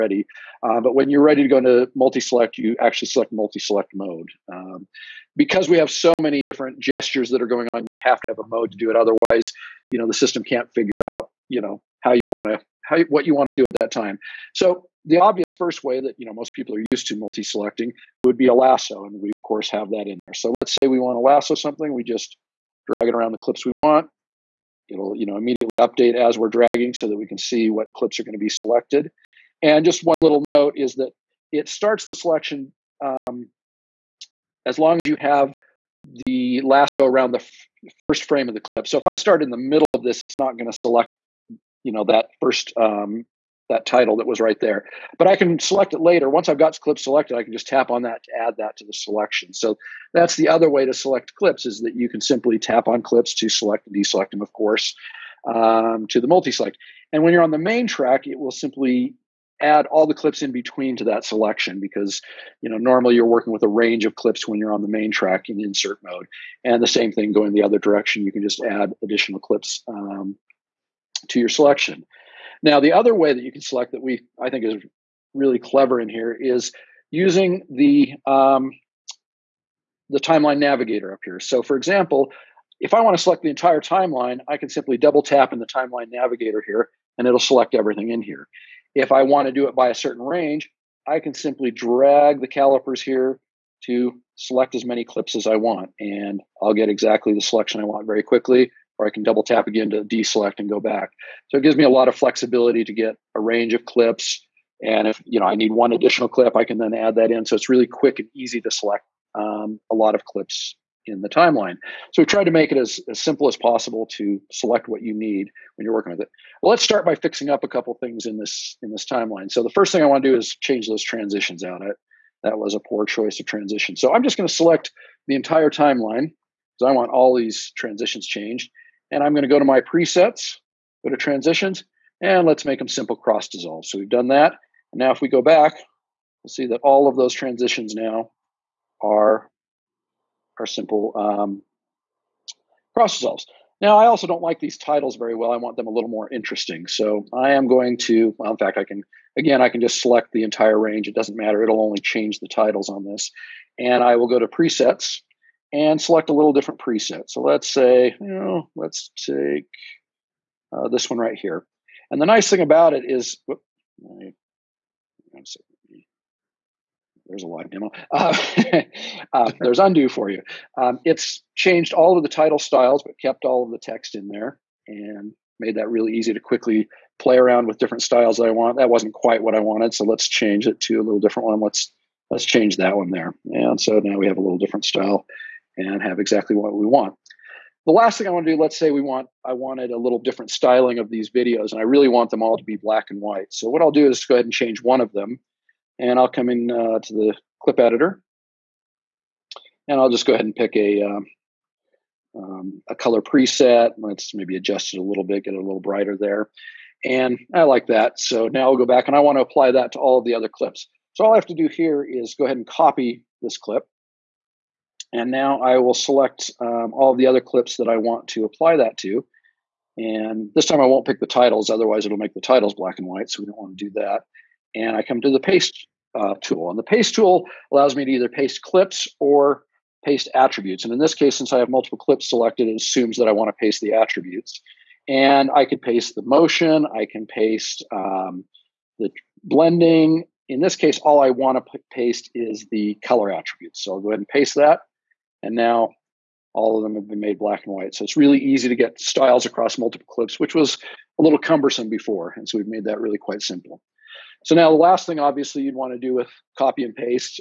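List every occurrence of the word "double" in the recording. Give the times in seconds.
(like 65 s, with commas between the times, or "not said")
84 s, 99 s.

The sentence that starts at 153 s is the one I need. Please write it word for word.
And I will go to presets and select a little different preset.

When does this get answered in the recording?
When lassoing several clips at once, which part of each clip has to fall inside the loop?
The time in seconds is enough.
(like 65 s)
38 s.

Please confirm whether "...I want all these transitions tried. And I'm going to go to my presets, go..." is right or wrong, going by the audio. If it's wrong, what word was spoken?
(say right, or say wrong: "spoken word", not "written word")
wrong: "changed", not "tried".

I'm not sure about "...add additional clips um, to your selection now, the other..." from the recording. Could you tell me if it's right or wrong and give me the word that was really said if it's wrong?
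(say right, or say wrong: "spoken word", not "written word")
right.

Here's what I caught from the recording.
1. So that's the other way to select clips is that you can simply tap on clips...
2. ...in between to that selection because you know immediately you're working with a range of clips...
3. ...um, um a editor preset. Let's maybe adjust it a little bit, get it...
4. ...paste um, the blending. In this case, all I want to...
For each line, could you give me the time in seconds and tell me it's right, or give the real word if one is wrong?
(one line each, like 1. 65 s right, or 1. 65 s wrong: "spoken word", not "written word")
1. 49 s right
2. 60 s wrong: "normally", not "immediately"
3. 201 s wrong: "color", not "editor"
4. 237 s right.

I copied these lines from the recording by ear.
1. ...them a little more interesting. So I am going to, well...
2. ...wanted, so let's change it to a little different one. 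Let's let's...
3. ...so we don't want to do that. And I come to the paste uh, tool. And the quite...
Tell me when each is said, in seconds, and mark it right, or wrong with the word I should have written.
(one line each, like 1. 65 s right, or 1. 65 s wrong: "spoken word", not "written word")
1. 145 s right
2. 179 s right
3. 223 s wrong: "paste", not "quite".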